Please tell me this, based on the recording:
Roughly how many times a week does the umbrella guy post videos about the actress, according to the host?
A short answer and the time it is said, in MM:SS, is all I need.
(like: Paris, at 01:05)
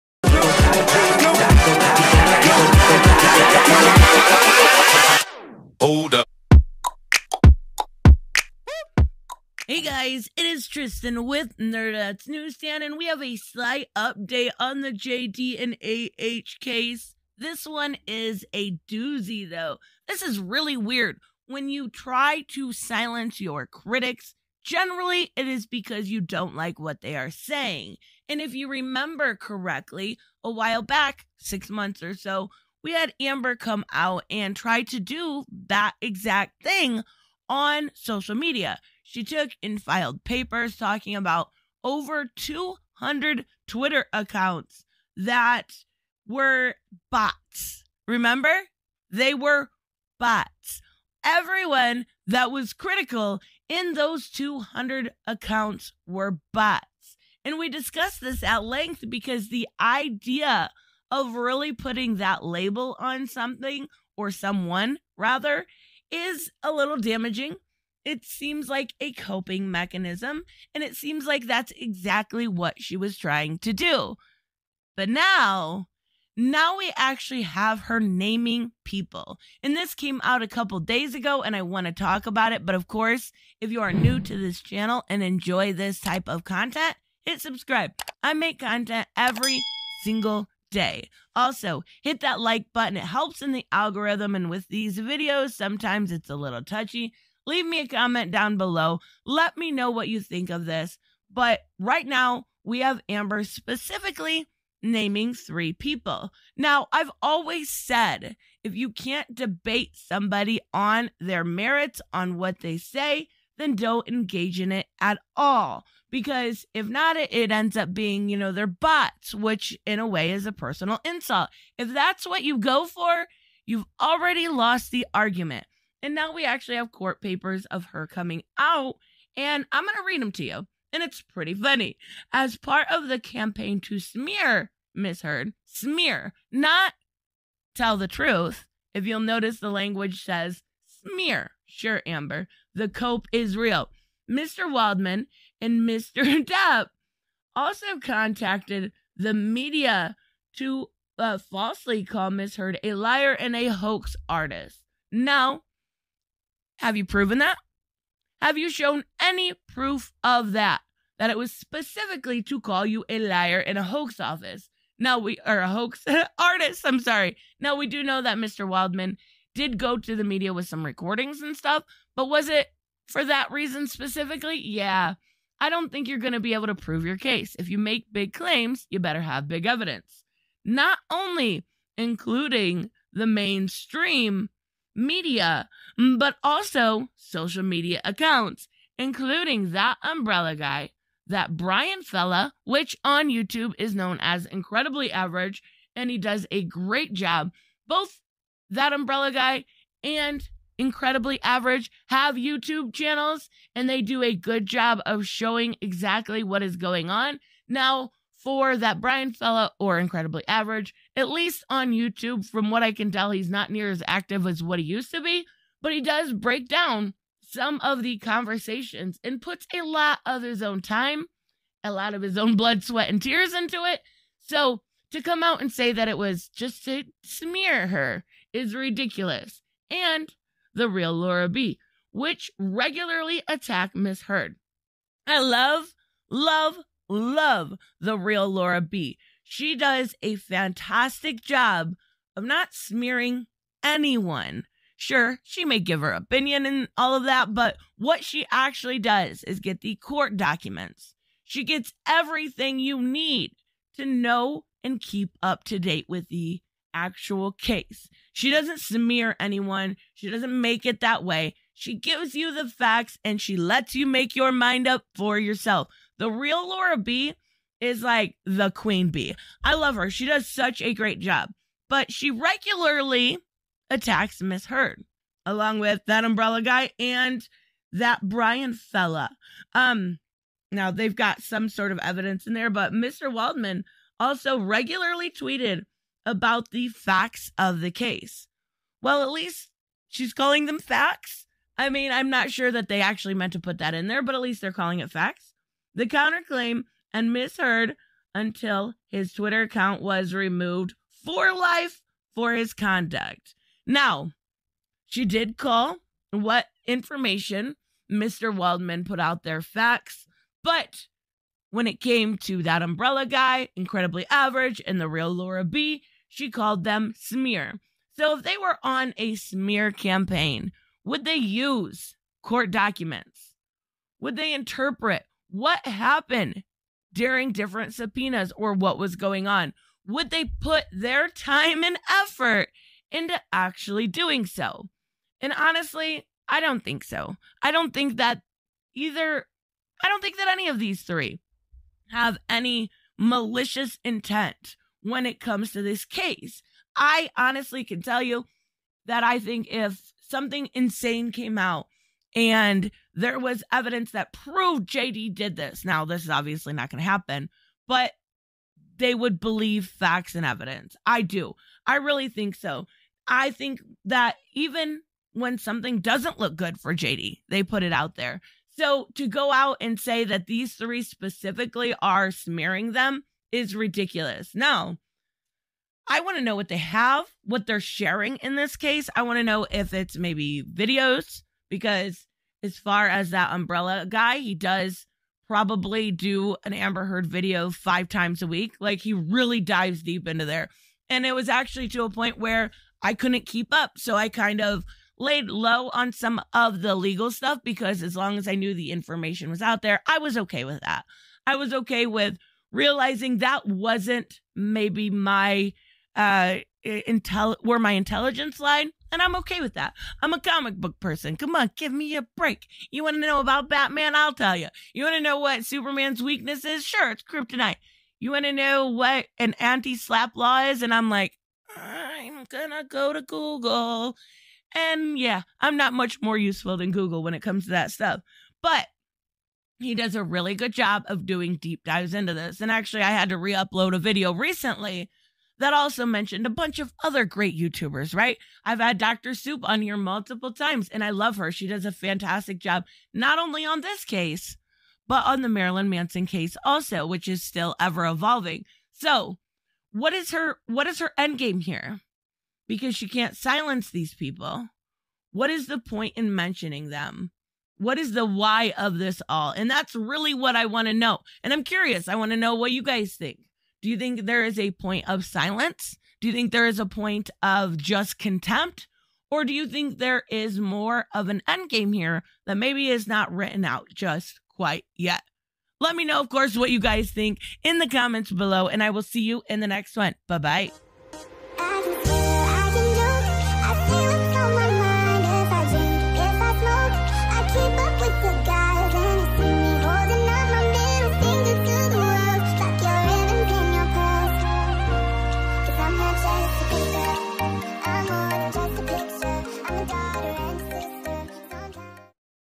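5, at 06:27.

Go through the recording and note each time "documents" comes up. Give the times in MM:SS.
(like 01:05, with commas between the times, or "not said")
04:10, 05:22.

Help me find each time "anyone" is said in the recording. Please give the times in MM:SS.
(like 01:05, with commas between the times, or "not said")
04:03, 04:19.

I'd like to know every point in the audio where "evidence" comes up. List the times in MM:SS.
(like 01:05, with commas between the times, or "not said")
02:59, 04:41, 05:53, 06:00.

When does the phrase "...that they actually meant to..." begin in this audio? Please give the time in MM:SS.
04:52.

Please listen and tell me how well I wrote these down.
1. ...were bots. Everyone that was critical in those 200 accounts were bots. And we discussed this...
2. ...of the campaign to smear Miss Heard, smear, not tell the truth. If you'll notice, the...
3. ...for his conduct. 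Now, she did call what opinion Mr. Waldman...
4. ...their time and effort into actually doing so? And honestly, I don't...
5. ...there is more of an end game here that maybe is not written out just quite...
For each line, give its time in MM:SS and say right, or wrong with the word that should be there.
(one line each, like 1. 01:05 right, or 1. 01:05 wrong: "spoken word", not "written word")
1. 00:49 right
2. 02:12 right
3. 05:02 wrong: "information", not "opinion"
4. 05:30 right
5. 07:49 right.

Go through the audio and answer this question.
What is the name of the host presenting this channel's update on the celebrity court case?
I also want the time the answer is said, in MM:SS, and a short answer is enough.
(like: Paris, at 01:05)
Tristan, at 00:10.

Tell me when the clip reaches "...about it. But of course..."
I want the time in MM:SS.
01:22.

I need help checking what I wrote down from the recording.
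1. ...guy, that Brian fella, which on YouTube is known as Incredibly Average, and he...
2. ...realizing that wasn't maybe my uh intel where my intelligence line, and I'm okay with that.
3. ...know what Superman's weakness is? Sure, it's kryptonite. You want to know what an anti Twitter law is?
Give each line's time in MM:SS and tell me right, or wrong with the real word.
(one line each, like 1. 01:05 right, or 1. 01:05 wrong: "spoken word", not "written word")
1. 03:10 right
2. 06:42 right
3. 06:55 wrong: "SLAPP", not "Twitter".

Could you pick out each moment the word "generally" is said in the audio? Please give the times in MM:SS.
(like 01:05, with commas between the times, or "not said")
00:24.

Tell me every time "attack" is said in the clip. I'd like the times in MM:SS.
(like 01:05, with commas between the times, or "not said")
03:53, 04:33.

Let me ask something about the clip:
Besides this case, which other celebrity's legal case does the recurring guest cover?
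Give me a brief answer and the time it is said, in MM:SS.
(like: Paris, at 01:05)
Marilyn Manson, at 07:25.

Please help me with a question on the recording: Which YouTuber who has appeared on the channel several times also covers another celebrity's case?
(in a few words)
Dr. Soup.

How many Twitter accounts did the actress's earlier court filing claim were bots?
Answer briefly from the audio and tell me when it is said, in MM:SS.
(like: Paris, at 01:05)
over 200, at 00:41.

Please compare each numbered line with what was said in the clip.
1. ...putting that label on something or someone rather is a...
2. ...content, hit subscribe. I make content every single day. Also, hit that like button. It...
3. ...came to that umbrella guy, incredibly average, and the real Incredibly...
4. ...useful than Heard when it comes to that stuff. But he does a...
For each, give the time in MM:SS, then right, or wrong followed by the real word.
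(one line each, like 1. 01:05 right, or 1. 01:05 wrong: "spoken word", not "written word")
1. 01:01 right
2. 01:26 right
3. 05:12 wrong: "Laura", not "Incredibly"
4. 07:06 wrong: "Google", not "Heard".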